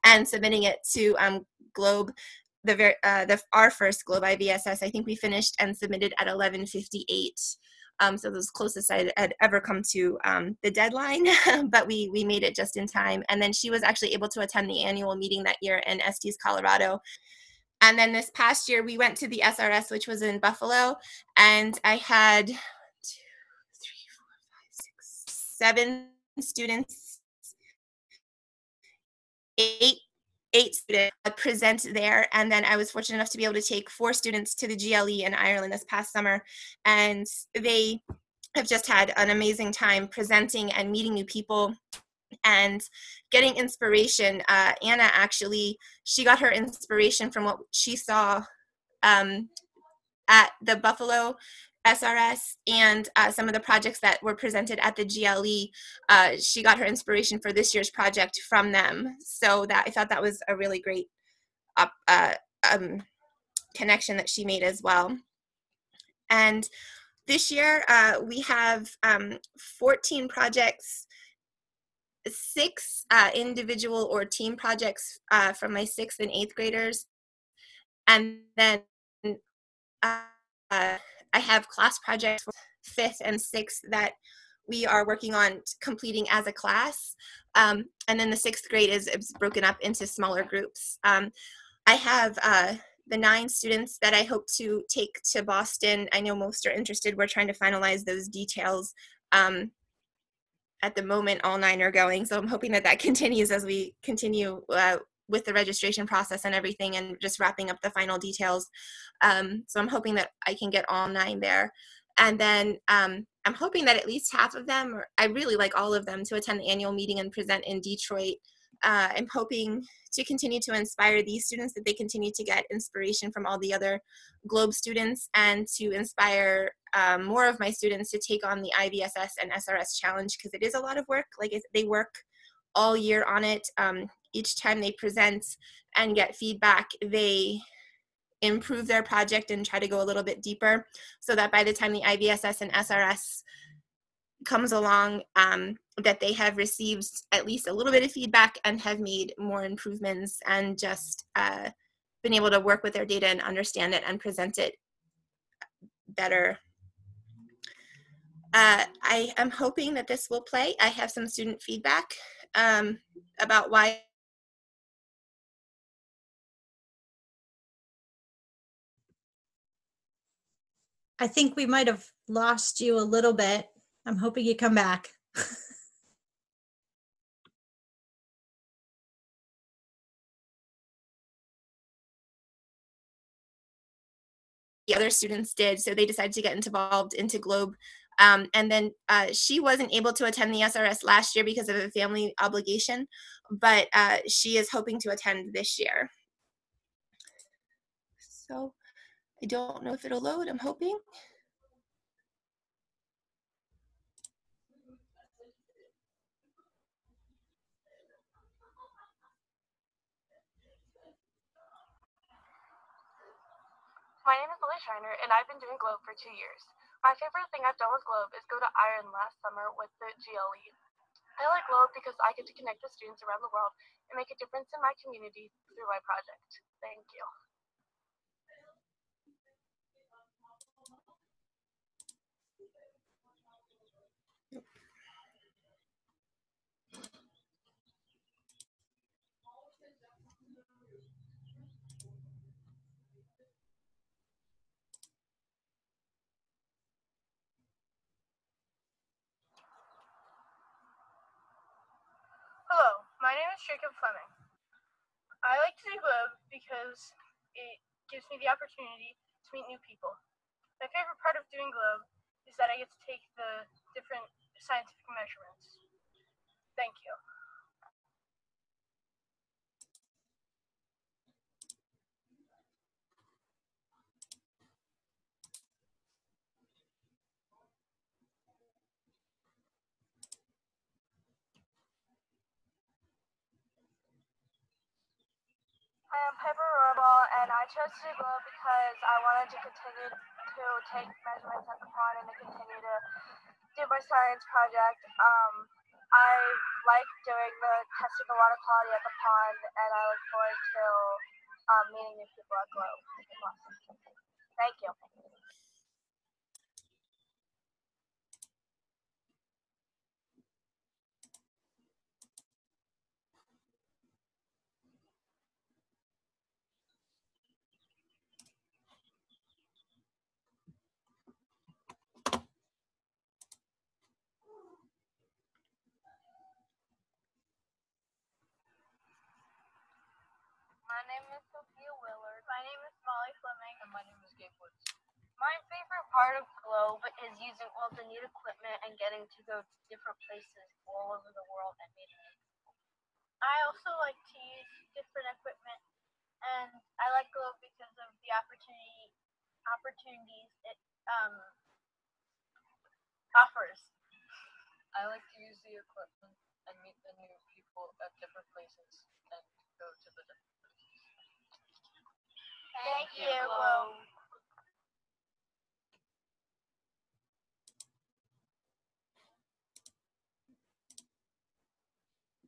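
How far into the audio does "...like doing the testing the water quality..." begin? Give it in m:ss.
4:56.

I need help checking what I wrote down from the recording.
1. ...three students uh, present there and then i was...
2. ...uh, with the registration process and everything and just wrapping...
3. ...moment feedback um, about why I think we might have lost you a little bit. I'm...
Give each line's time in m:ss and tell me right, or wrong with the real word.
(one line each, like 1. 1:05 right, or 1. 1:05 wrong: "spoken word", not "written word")
1. 0:30 wrong: "eight", not "three"
2. 1:44 right
3. 2:41 wrong: "student", not "moment".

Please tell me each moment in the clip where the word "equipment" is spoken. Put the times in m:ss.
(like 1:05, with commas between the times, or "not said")
5:38, 5:45, 5:55.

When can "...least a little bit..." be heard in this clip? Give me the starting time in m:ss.
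2:27.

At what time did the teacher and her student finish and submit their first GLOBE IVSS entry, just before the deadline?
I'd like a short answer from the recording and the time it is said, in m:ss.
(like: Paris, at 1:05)
11:58, at 0:06.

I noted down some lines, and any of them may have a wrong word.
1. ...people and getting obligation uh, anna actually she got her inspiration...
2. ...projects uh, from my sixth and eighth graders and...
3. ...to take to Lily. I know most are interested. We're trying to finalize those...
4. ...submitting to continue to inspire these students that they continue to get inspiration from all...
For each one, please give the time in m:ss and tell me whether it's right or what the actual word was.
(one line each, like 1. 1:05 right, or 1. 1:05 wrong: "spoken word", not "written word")
1. 0:41 wrong: "inspiration", not "obligation"
2. 1:14 right
3. 1:34 wrong: "Boston", not "Lily"
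4. 1:59 wrong: "hoping", not "submitting".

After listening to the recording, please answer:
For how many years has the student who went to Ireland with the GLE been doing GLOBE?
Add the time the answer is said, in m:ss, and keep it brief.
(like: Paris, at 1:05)
2, at 3:36.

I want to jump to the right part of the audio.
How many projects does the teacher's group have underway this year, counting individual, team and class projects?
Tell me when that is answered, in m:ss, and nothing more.
1:09.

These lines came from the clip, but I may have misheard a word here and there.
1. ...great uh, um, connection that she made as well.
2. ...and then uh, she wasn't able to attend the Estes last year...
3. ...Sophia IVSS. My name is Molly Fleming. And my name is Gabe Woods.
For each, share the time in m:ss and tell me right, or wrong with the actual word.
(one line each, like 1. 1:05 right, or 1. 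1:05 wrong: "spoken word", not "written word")
1. 1:00 right
2. 3:08 wrong: "SRS", not "Estes"
3. 5:31 wrong: "Willard", not "IVSS".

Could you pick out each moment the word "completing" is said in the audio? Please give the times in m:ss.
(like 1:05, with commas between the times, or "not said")
1:25.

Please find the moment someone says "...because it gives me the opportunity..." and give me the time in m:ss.
4:16.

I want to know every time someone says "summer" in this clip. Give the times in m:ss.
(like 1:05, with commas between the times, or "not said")
0:36, 3:39.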